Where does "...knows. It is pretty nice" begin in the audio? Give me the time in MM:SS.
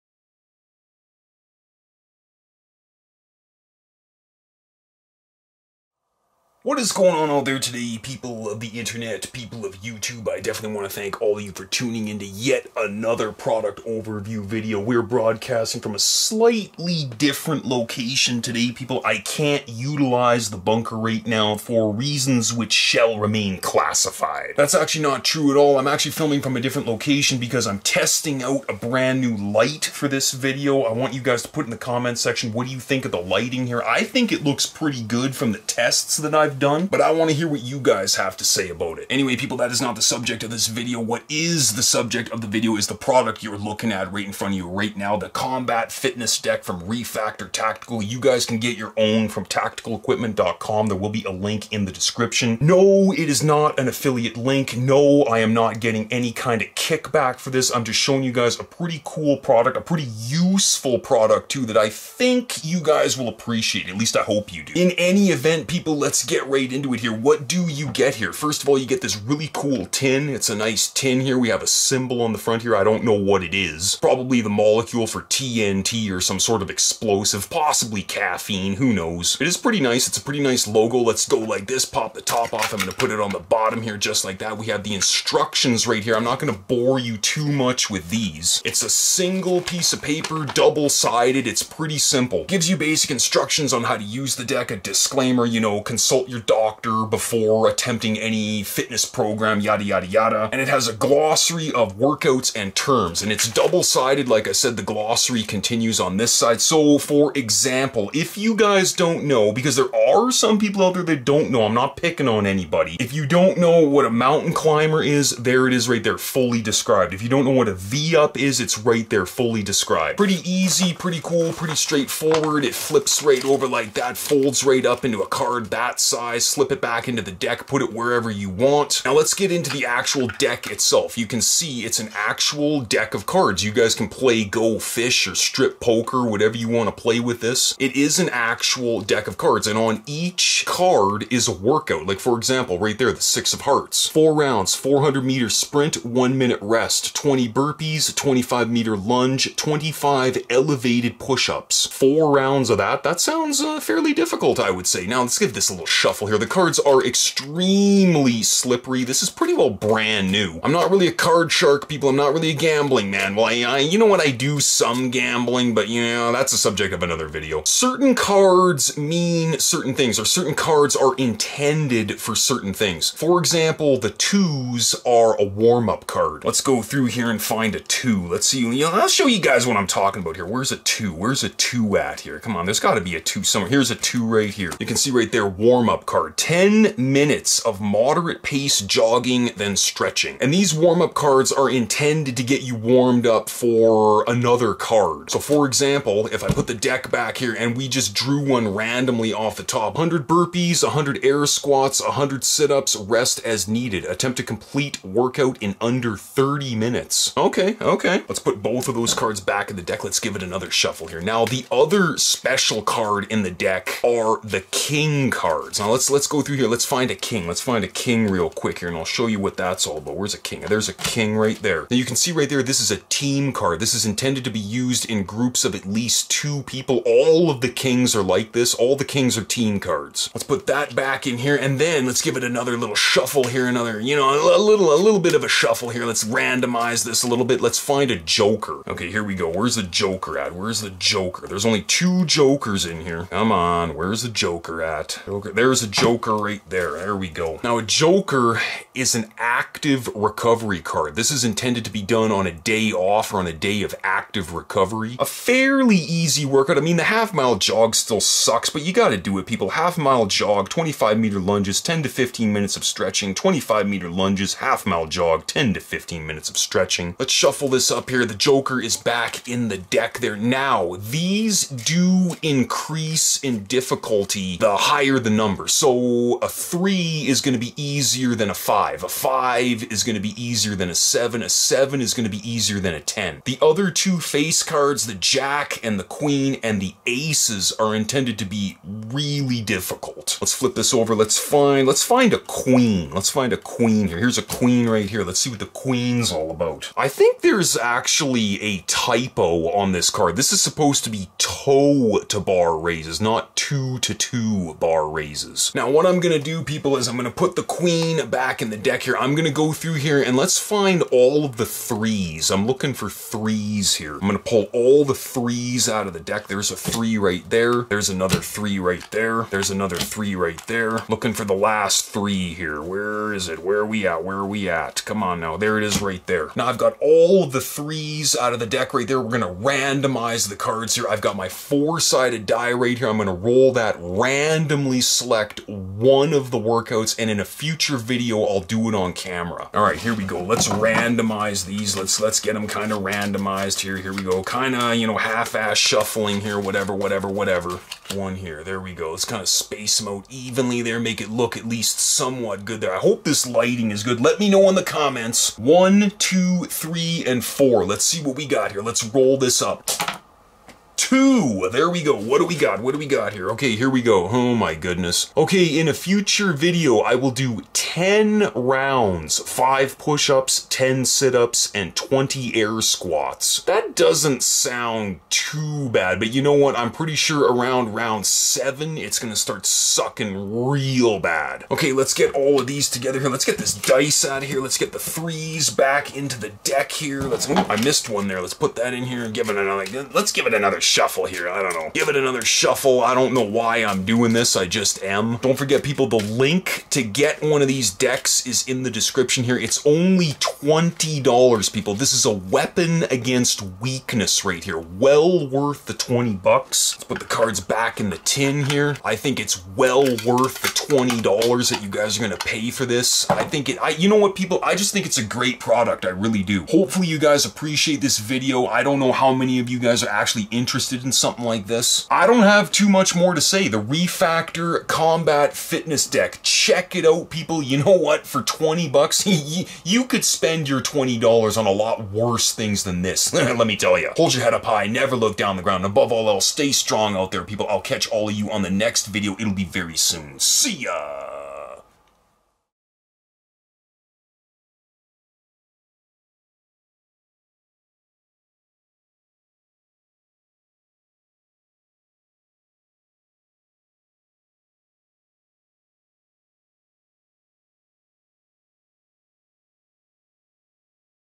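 01:18.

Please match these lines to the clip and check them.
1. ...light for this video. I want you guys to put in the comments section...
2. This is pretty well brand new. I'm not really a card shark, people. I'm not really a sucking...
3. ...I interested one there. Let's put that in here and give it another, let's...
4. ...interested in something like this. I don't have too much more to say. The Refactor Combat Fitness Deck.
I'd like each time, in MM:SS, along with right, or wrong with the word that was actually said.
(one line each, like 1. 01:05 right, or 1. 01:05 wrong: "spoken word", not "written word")
1. 00:29 right
2. 02:39 wrong: "gambling", not "sucking"
3. 06:27 wrong: "missed", not "interested"
4. 07:00 right.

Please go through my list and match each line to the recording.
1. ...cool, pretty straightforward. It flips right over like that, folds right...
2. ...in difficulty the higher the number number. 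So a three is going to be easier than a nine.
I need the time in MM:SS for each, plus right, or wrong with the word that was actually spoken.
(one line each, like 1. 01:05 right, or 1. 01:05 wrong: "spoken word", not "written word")
1. 02:01 right
2. 04:33 wrong: "five", not "nine".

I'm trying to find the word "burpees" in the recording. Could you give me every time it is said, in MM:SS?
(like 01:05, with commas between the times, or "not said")
02:27, 03:20.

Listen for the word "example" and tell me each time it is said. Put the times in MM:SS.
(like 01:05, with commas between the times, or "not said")
01:47, 02:22, 02:53, 03:15.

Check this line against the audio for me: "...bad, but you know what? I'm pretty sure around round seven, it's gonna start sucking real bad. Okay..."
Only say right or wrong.
right.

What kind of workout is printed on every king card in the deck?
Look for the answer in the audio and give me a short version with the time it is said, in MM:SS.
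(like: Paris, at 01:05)
Team card, at 03:43.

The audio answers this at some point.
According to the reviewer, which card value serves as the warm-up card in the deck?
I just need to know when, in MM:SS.
02:53.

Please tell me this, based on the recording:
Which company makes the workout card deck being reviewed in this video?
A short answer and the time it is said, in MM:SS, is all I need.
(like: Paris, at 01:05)
Refactor Tactical, at 00:46.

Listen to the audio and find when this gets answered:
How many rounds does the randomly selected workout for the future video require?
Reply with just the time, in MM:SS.
06:07.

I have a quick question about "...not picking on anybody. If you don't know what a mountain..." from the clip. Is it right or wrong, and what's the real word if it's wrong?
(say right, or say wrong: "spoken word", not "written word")
right.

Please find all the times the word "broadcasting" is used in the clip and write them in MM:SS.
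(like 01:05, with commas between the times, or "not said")
00:15.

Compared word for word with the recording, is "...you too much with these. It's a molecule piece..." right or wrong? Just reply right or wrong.
wrong.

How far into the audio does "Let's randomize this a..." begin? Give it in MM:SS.
03:56.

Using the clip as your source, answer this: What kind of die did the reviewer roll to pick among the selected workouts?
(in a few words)
Four-sided die.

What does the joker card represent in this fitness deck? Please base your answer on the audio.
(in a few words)
Active recovery card.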